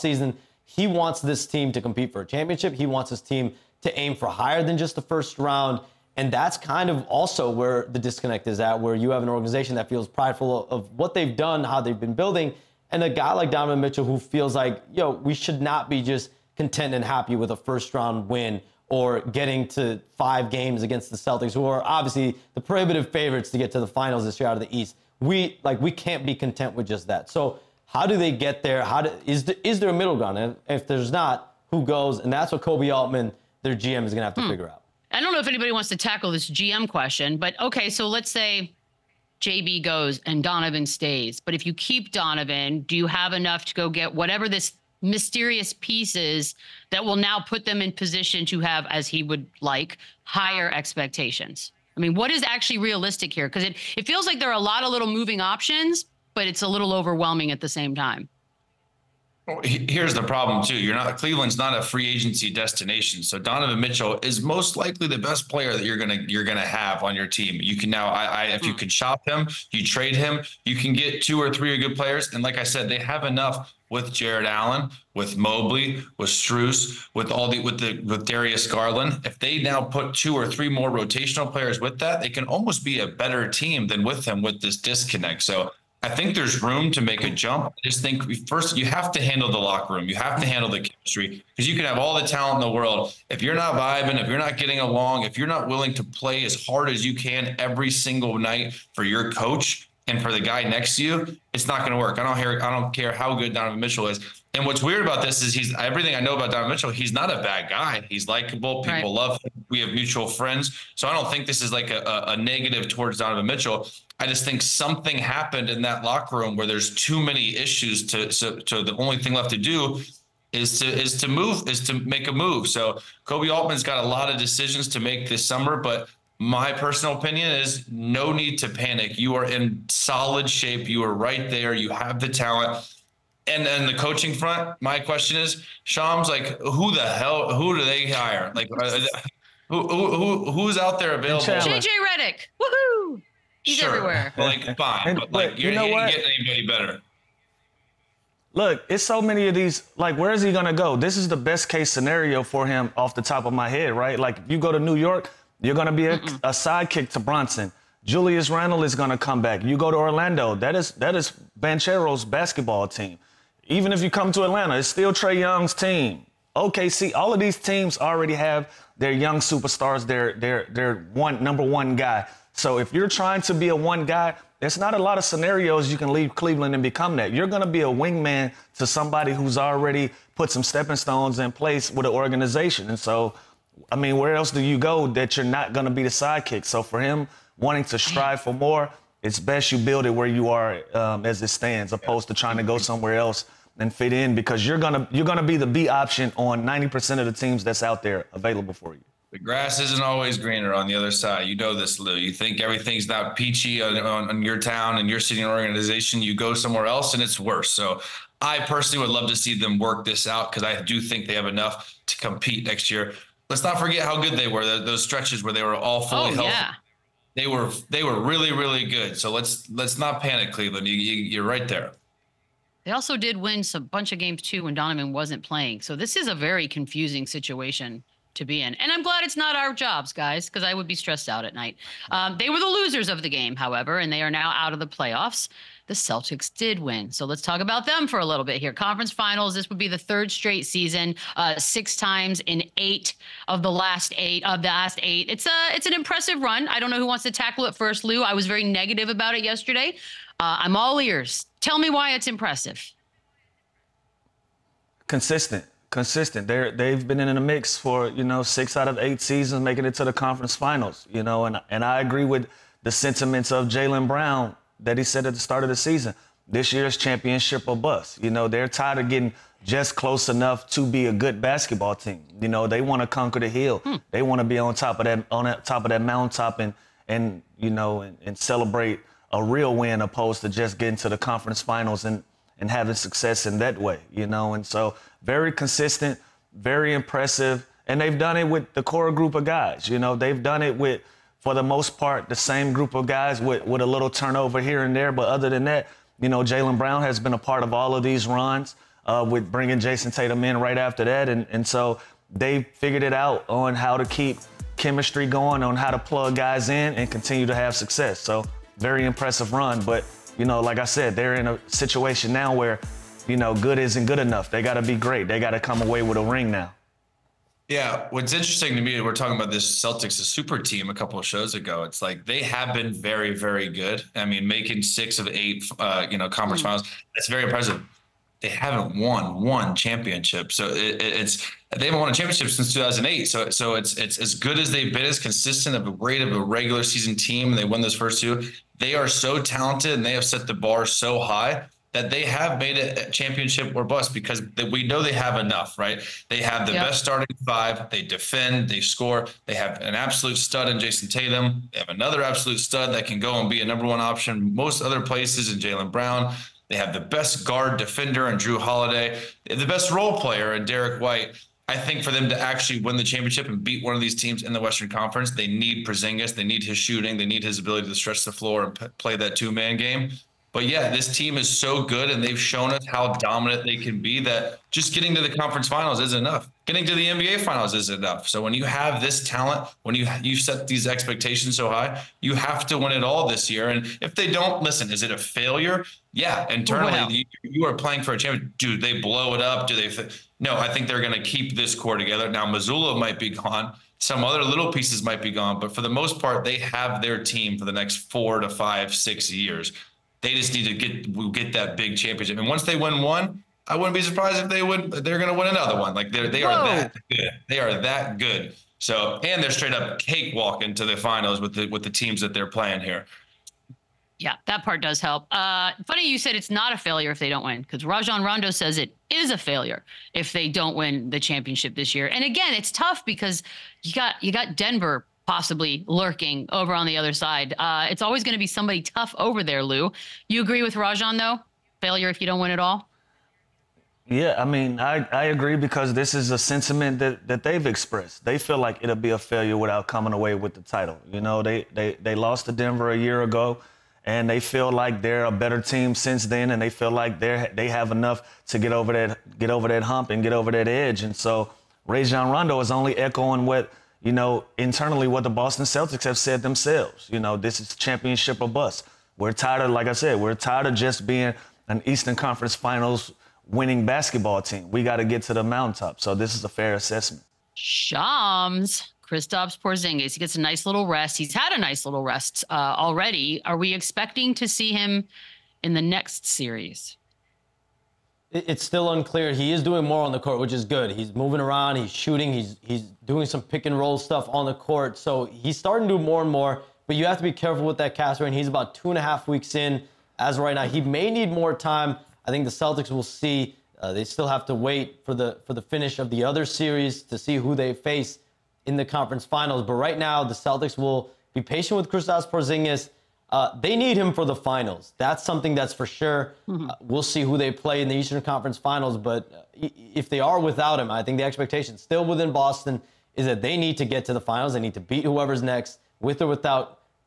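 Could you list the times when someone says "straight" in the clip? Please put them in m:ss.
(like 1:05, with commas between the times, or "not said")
4:00, 6:49.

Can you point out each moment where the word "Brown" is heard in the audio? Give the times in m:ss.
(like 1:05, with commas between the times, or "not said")
4:24, 4:56, 5:55.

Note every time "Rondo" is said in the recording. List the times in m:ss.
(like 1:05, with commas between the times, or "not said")
6:58, 7:32.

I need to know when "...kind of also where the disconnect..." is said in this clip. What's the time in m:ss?
0:06.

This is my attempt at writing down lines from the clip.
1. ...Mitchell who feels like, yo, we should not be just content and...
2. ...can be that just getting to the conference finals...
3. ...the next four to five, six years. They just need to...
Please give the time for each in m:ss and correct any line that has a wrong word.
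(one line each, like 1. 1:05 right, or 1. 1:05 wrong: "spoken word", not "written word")
1. 0:13 right
2. 6:13 right
3. 6:37 right.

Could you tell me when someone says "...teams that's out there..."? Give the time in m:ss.
3:17.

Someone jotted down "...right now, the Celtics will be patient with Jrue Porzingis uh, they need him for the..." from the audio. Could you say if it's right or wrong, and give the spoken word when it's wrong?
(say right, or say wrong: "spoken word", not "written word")
wrong: "Kristaps", not "Jrue".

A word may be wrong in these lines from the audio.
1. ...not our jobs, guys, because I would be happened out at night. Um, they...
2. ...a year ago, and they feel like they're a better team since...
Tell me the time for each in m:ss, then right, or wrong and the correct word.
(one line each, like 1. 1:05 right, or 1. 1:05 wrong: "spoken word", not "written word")
1. 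3:49 wrong: "stressed", not "happened"
2. 7:22 right.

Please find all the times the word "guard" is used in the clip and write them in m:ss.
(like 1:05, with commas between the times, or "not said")
5:57.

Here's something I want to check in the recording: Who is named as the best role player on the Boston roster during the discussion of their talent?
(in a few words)
Derrick White.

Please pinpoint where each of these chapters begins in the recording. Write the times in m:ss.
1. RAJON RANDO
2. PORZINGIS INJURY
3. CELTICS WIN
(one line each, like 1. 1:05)
1. 6:54
2. 7:46
3. 3:56.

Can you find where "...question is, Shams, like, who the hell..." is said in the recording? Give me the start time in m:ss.
2:15.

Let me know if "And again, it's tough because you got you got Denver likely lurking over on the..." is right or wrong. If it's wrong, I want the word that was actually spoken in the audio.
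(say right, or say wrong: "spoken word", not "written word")
wrong: "possibly", not "likely".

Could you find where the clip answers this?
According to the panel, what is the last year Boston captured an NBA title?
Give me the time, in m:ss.
5:32.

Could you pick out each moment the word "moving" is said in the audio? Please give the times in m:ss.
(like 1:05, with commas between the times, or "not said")
0:55, 8:01.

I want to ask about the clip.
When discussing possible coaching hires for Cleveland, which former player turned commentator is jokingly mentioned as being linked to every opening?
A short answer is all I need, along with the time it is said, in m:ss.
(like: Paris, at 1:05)
JJ Redick, at 2:21.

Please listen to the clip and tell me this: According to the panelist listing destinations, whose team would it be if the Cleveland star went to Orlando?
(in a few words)
Banchero.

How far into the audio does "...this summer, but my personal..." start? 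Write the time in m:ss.
2:05.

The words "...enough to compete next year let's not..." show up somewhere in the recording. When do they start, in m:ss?
3:31.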